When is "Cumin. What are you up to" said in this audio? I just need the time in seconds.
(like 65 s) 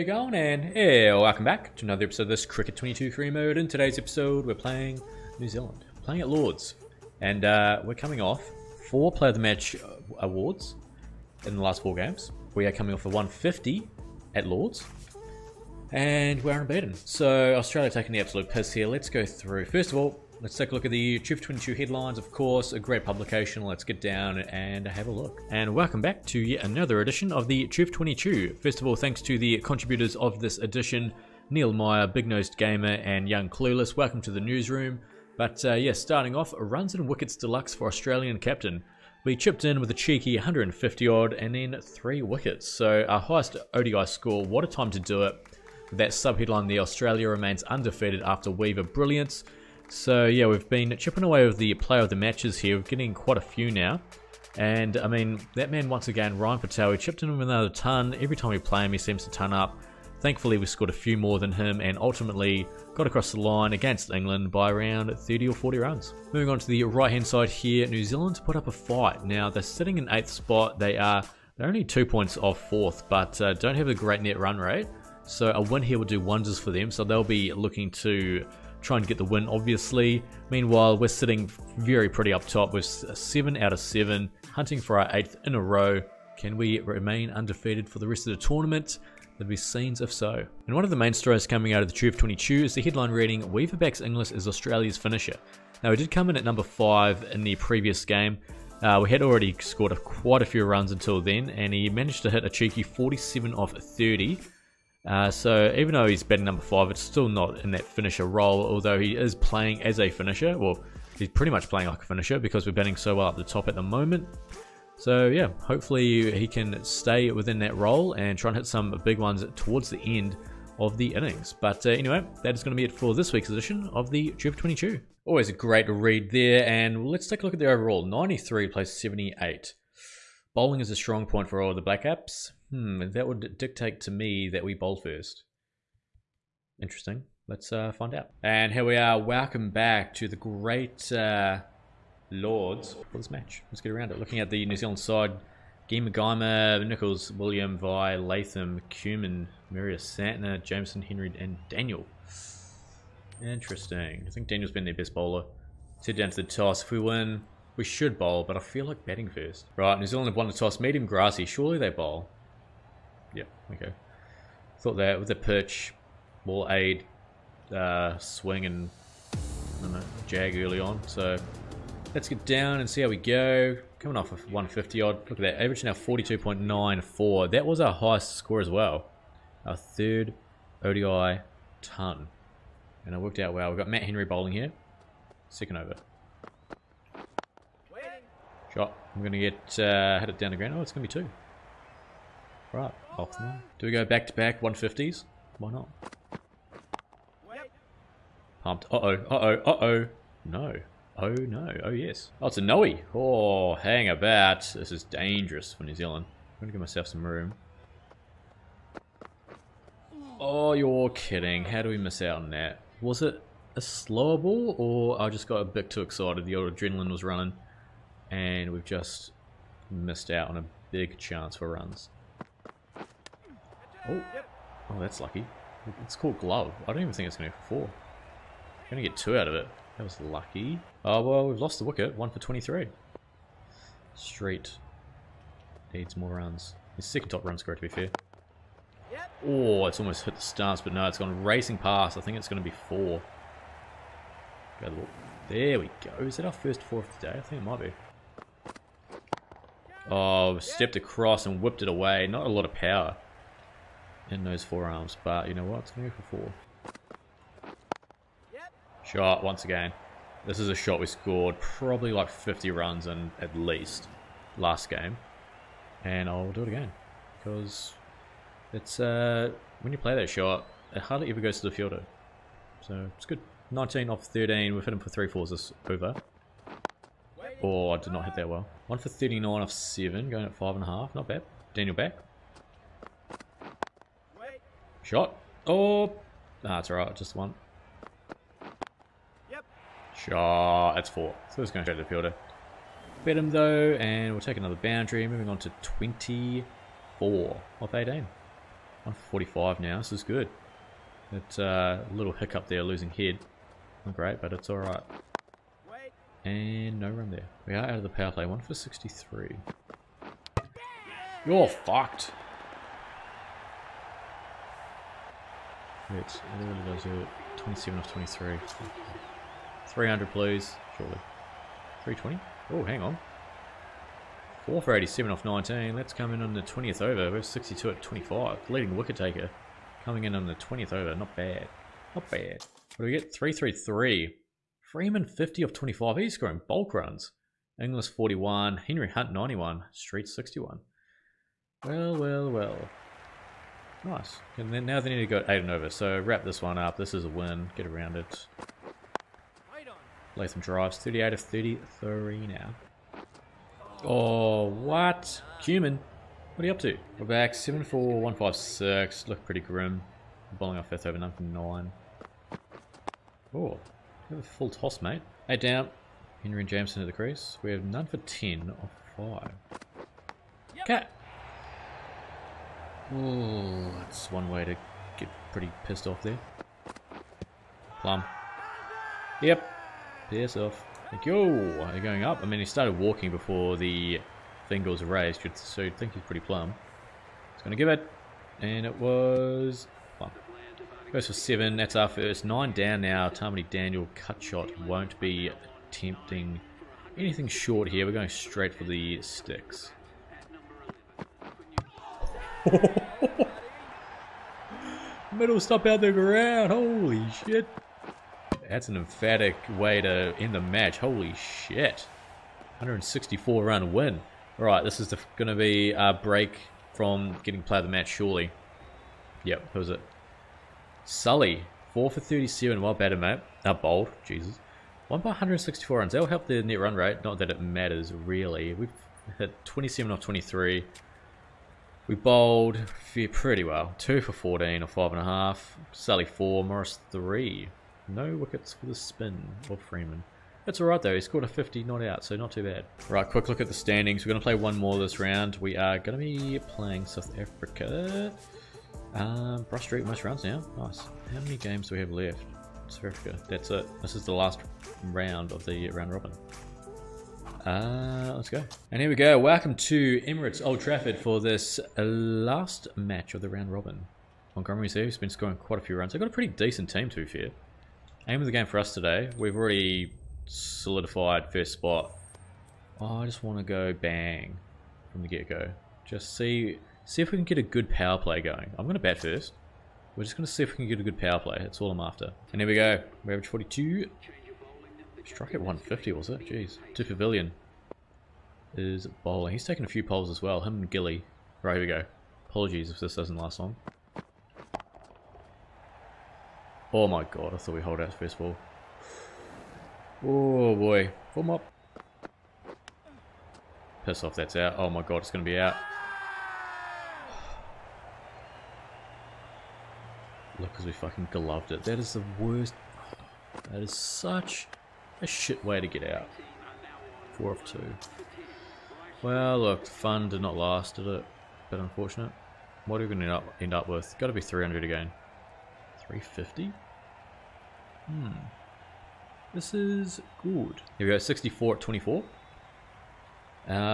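355 s.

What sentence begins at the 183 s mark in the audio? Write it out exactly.
We've got Matt Henry bowling here.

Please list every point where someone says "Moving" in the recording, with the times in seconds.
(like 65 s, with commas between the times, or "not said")
66 s, 295 s.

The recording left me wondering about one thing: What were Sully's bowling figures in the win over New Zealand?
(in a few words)
4 for 37.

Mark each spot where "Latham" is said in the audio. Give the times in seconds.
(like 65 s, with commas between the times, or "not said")
148 s, 350 s.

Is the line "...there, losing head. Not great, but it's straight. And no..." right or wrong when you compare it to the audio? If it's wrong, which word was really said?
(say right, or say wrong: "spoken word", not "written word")
wrong: "alright", not "straight".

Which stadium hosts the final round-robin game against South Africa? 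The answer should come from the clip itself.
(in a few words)
Emirates Old Trafford.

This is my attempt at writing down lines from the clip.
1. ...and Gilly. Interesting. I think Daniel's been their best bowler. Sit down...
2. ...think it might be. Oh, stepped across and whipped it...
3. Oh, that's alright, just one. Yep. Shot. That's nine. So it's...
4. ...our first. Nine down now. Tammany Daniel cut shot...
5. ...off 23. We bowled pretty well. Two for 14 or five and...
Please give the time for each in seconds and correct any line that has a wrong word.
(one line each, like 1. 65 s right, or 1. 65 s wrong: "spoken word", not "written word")
1. 151 s wrong: "Daniel", not "Gilly"
2. 247 s right
3. 285 s wrong: "four", not "nine"
4. 391 s right
5. 430 s right.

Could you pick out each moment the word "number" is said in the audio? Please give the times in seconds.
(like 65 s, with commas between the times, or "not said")
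96 s, 106 s, 361 s.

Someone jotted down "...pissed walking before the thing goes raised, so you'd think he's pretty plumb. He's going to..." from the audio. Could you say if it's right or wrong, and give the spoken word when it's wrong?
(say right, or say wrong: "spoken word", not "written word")
wrong: "started", not "pissed".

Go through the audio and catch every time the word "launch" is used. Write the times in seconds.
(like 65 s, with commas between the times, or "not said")
not said.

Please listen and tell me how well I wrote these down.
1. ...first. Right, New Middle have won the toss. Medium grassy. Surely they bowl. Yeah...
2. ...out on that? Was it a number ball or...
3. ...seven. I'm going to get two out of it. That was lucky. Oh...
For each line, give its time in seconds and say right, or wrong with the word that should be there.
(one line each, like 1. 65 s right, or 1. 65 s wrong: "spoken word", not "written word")
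1. 159 s wrong: "Zealand", not "Middle"
2. 212 s wrong: "slower", not "number"
3. 227 s wrong: "four", not "seven".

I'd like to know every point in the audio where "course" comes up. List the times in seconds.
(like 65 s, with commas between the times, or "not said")
22 s.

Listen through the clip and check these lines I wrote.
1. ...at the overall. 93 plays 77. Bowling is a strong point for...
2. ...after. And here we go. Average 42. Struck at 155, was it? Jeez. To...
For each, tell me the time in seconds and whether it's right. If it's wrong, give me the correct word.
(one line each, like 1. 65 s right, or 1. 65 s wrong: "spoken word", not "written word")
1. 127 s wrong: "78", not "77"
2. 481 s wrong: "150", not "155".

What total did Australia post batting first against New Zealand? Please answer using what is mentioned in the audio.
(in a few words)
333.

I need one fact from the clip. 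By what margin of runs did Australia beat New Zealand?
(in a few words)
164.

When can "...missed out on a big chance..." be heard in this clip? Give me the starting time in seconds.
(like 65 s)
219 s.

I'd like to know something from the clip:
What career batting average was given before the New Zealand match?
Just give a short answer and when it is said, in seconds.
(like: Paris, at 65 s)
42.94, at 175 s.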